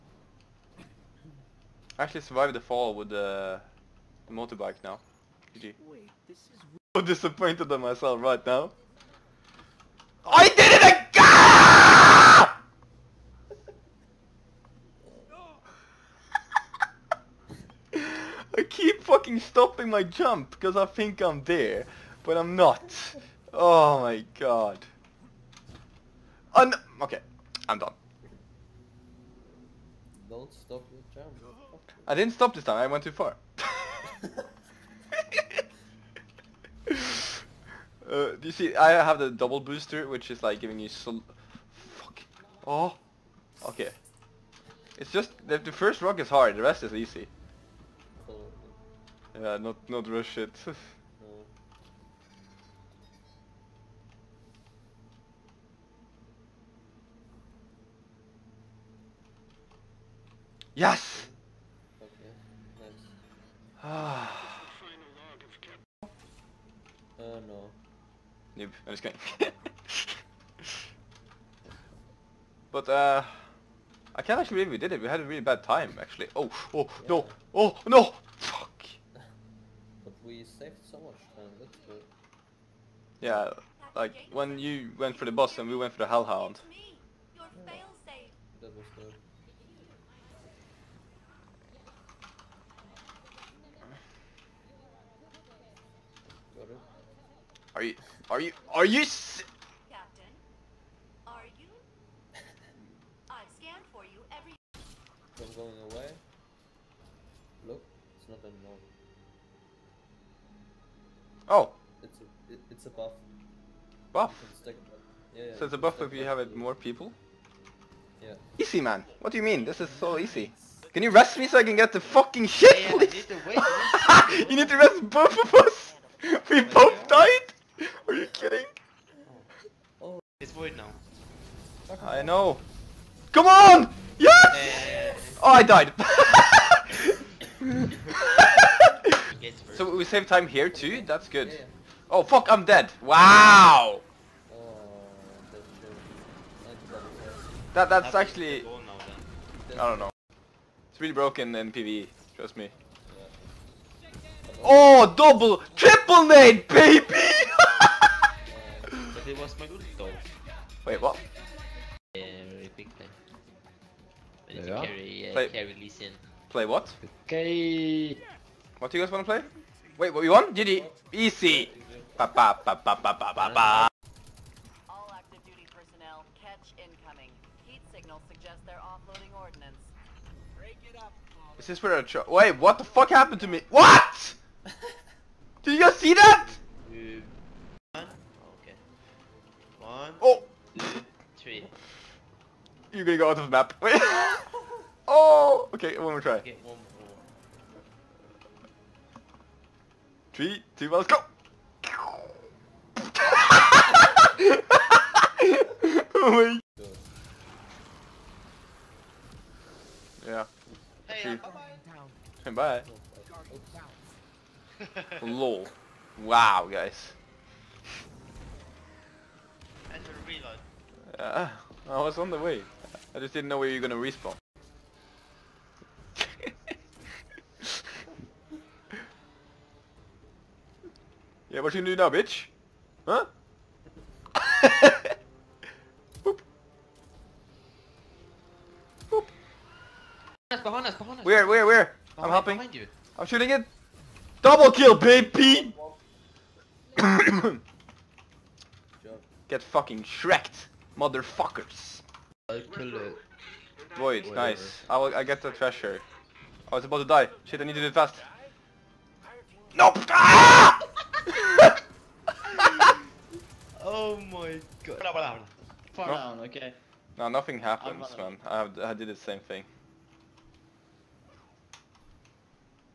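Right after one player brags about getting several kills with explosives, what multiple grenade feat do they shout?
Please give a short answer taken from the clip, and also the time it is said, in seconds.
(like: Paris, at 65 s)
triple nade, at 155 s.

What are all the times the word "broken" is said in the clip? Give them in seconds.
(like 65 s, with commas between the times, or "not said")
151 s.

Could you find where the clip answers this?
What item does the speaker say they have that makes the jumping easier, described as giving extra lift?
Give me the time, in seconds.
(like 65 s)
39 s.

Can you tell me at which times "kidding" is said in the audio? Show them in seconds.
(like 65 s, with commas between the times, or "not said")
69 s, 128 s.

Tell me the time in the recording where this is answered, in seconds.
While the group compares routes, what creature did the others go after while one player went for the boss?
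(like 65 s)
86 s.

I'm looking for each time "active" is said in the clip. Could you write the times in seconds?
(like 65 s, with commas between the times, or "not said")
175 s.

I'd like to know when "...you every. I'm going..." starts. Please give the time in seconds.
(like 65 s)
104 s.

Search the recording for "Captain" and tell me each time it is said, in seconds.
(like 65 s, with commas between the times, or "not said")
99 s.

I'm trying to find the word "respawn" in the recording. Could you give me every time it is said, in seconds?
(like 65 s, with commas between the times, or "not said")
224 s.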